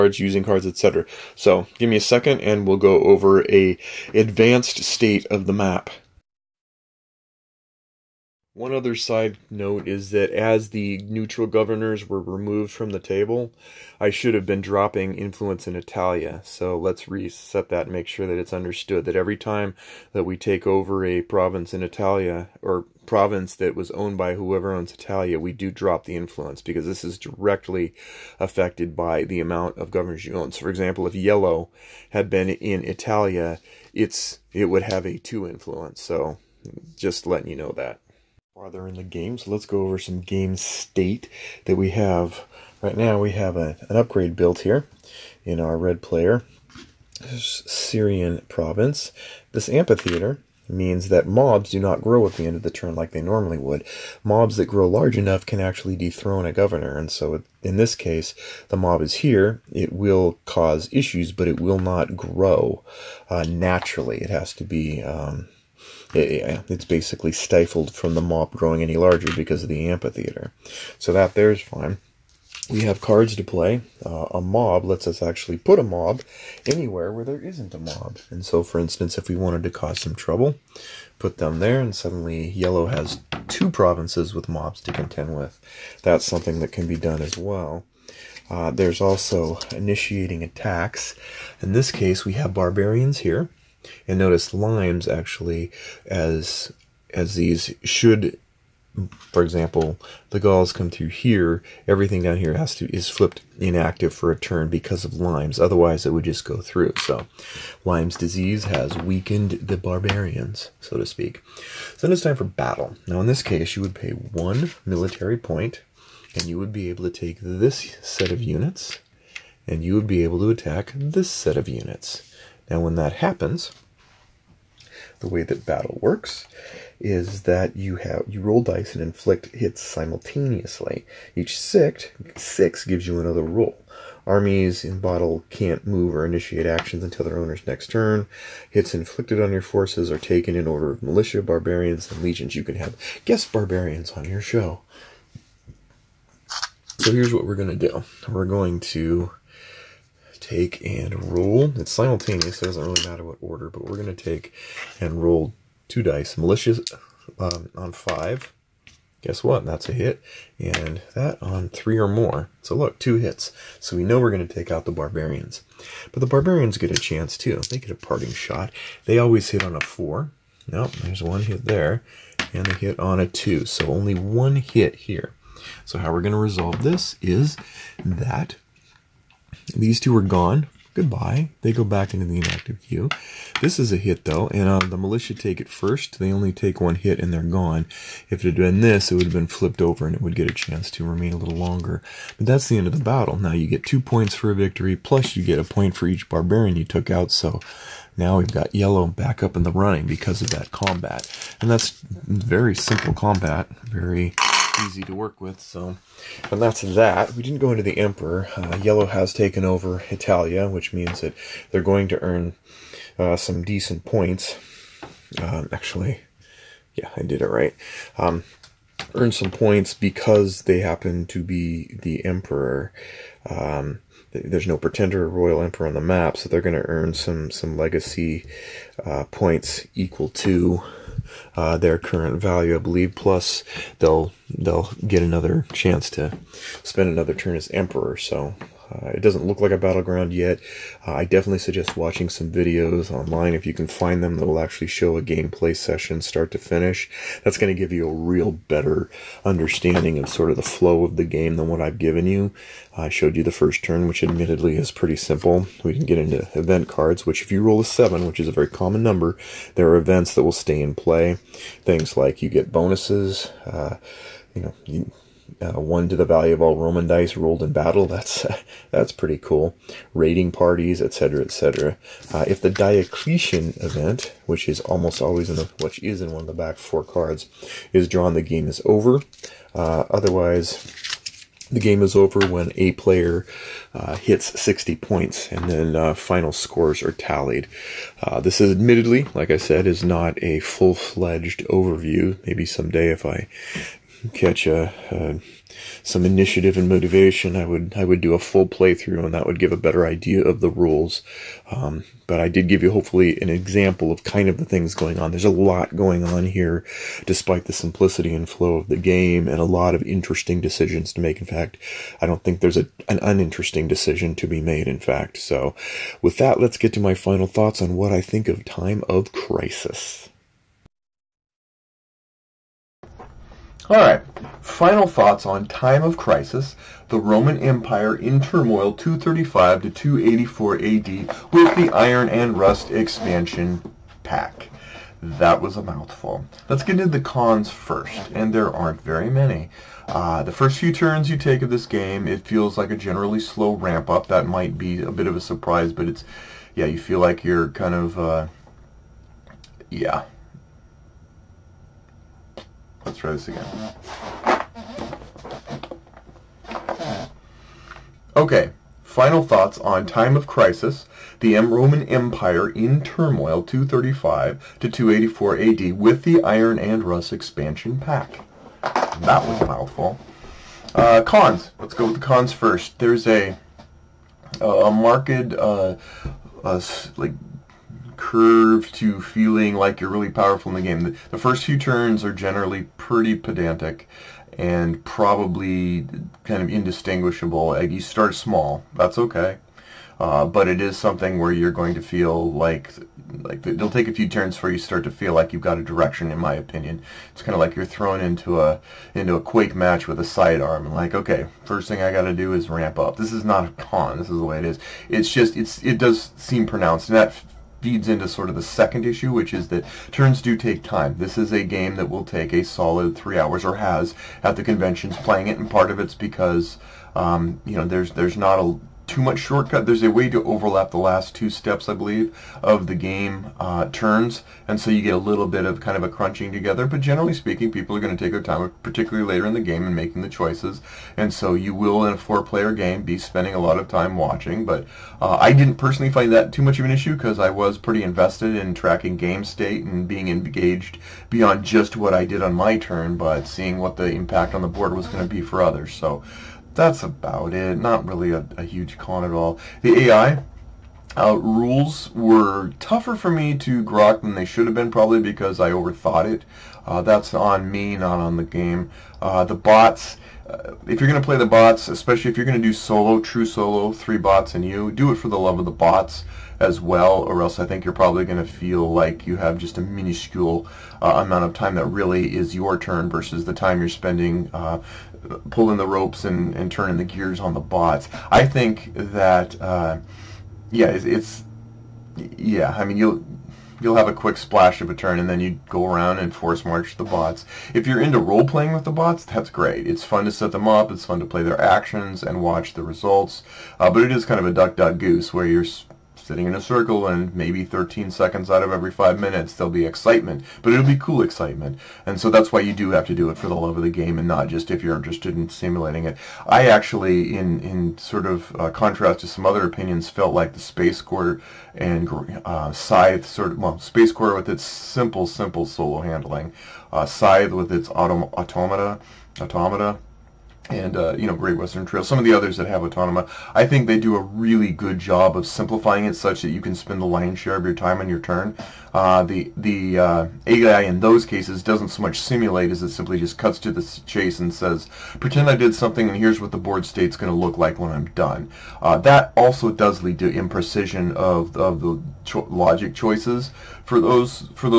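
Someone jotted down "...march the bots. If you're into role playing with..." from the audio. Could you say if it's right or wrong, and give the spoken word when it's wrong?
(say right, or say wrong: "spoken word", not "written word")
right.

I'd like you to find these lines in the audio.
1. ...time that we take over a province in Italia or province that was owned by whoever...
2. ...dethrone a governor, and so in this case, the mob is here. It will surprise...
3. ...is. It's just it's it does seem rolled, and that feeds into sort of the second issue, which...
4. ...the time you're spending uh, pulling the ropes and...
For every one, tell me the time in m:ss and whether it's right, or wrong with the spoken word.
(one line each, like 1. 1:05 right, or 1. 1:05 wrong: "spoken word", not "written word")
1. 0:19 right
2. 0:55 wrong: "cause", not "surprise"
3. 6:44 wrong: "pronounced", not "rolled"
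4. 7:53 right.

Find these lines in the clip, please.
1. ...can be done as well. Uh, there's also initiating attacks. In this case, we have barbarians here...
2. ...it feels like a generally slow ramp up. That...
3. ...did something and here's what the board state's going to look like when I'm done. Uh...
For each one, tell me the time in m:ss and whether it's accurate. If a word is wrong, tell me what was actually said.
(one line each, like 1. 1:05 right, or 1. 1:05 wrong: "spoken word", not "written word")
1. 1:26 right
2. 5:42 right
3. 8:55 right.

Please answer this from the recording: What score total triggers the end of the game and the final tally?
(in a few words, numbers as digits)
60 points.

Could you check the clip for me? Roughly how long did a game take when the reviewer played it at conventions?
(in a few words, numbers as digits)
3 hours.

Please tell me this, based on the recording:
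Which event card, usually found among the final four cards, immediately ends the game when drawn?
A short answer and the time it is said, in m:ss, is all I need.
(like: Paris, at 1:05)
Diocletian, at 4:32.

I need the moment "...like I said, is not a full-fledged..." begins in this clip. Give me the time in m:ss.
4:49.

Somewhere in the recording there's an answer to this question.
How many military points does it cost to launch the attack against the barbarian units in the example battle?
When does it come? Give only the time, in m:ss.
1:54.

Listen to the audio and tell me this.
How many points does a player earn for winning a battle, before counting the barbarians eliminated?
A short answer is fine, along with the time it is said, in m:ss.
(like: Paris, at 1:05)
2, at 3:13.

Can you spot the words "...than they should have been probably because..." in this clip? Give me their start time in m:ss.
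7:34.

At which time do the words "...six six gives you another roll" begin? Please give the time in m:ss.
2:11.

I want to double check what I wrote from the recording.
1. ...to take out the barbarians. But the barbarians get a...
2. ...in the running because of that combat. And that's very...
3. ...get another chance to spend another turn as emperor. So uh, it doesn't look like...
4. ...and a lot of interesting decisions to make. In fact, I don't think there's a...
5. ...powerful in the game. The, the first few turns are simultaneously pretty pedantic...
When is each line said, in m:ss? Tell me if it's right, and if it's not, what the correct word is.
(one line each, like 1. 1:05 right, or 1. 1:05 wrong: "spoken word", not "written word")
1. 2:44 right
2. 3:19 right
3. 3:55 right
4. 5:09 right
5. 6:20 wrong: "generally", not "simultaneously".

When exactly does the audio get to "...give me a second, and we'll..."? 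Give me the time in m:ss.
0:01.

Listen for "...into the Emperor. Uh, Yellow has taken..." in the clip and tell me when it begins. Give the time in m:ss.
3:27.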